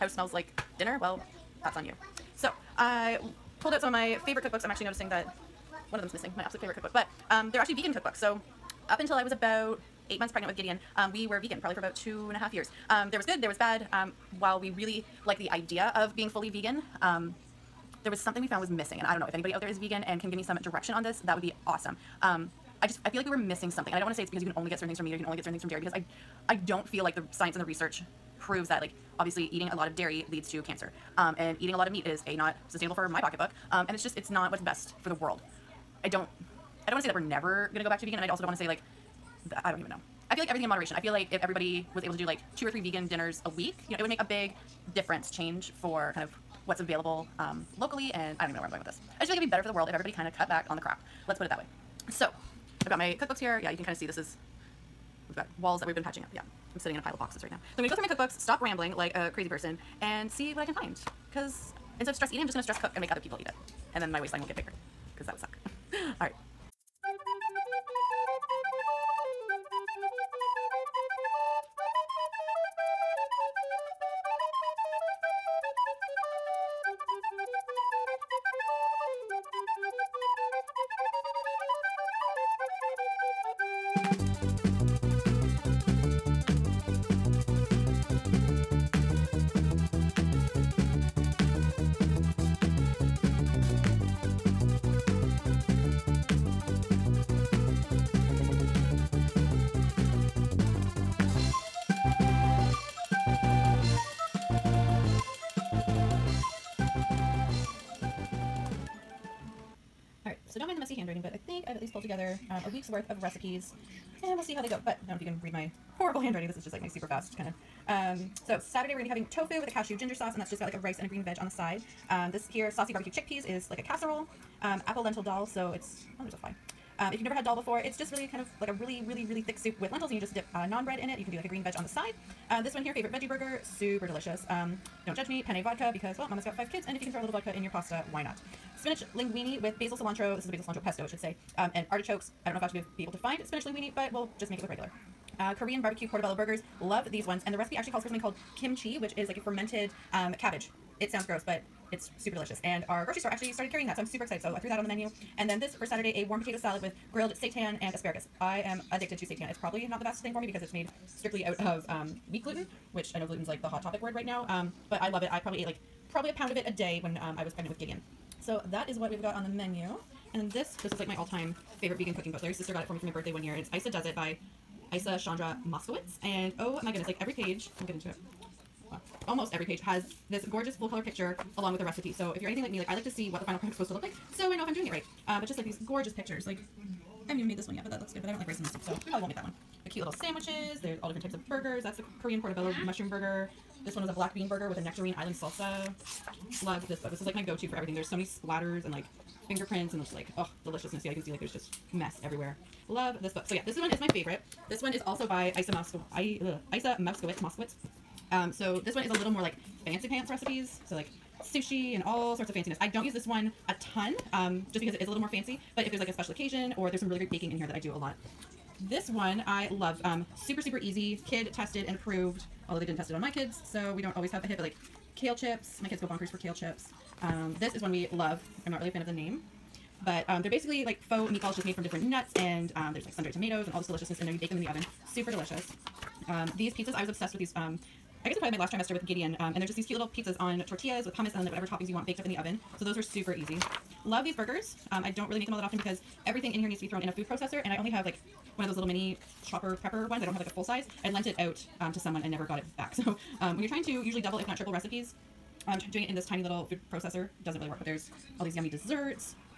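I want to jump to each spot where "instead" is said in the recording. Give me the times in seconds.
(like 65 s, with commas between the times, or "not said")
61 s.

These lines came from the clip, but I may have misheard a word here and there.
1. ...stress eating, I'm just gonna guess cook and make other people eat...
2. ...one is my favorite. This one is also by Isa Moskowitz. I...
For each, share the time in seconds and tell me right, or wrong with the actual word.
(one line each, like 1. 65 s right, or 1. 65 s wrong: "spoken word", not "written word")
1. 62 s wrong: "stress", not "guess"
2. 203 s right.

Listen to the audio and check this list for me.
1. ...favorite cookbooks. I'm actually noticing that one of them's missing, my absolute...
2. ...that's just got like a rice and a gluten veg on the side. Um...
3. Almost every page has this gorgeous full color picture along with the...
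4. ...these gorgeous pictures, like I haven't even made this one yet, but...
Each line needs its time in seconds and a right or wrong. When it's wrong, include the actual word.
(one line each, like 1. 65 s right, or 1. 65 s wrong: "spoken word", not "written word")
1. 4 s right
2. 120 s wrong: "green", not "gluten"
3. 179 s right
4. 185 s right.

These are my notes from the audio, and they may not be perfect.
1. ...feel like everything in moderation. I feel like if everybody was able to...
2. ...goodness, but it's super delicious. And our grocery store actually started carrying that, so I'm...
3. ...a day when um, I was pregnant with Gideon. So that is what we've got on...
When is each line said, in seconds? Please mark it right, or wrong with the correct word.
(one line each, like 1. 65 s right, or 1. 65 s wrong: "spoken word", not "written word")
1. 40 s right
2. 151 s wrong: "gross", not "goodness"
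3. 166 s right.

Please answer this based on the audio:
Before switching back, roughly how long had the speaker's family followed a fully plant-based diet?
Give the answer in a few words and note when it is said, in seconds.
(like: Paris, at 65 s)
2.5 years, at 11 s.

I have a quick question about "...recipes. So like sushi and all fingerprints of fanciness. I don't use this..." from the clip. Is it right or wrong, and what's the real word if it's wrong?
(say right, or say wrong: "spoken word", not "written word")
wrong: "sorts", not "fingerprints".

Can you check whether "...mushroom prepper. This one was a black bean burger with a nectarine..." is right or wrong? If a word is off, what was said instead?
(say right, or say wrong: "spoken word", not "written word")
wrong: "burger", not "prepper".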